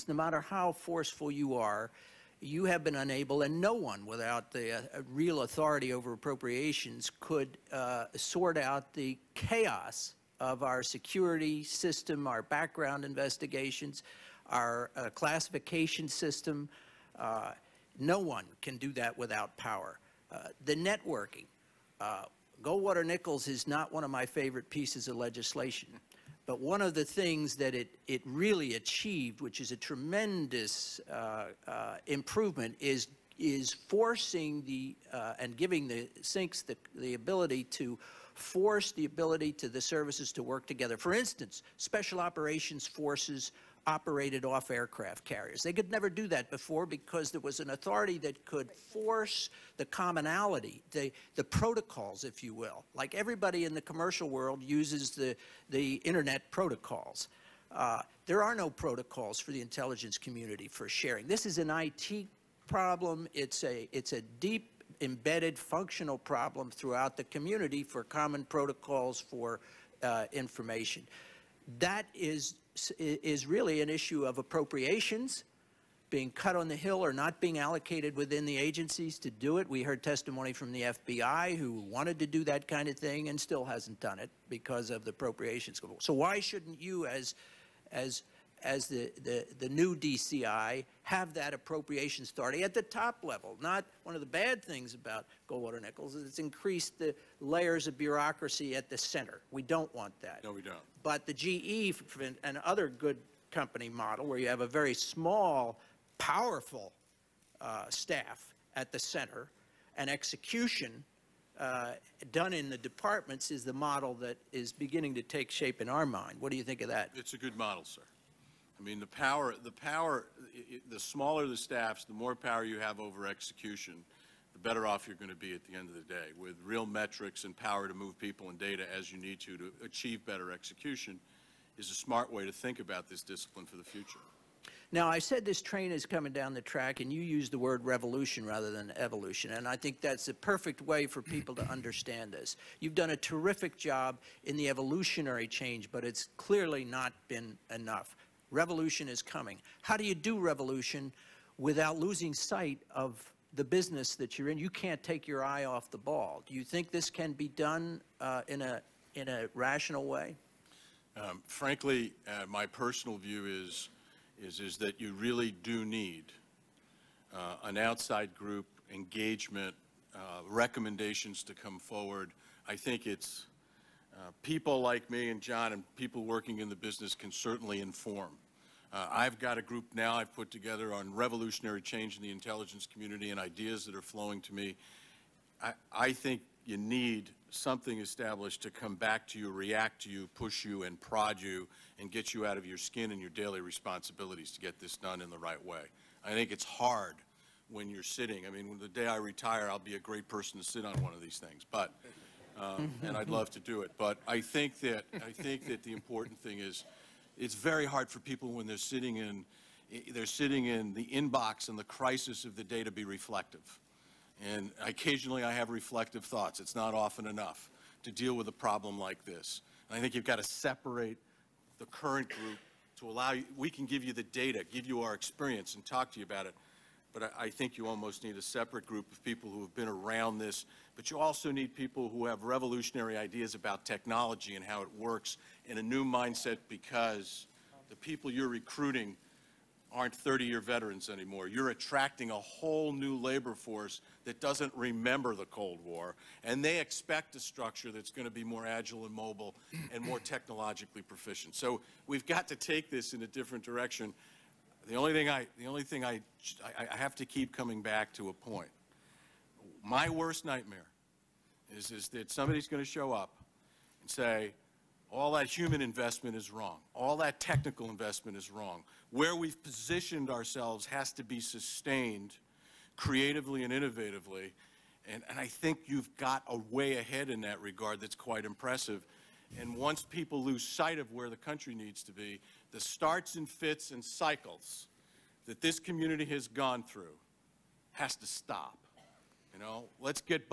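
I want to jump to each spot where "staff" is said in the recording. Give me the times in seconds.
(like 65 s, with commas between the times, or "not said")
107 s, 121 s.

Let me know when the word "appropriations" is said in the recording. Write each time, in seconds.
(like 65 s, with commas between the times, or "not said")
6 s, 74 s, 85 s, 91 s.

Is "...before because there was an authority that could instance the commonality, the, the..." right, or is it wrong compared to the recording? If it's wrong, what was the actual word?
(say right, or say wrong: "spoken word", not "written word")
wrong: "force", not "instance".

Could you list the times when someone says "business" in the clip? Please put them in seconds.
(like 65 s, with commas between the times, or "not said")
153 s, 176 s.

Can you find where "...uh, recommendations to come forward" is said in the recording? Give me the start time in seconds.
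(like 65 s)
170 s.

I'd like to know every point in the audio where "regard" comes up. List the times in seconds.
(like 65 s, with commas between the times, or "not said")
277 s.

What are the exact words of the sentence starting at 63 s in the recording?
It's a, it's a deep embedded functional problem throughout the community for common protocols for uh, information.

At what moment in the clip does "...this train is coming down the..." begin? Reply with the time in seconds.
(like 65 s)
135 s.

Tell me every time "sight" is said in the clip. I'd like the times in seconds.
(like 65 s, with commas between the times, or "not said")
152 s, 280 s.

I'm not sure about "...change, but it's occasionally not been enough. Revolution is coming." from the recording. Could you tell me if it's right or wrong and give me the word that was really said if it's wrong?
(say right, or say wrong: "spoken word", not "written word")
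wrong: "clearly", not "occasionally".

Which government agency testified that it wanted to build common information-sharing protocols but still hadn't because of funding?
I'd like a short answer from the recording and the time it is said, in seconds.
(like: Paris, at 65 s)
FBI, at 80 s.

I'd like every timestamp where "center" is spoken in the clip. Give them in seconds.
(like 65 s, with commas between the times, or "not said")
98 s, 108 s.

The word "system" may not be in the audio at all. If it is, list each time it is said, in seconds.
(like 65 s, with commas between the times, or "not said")
11 s, 16 s.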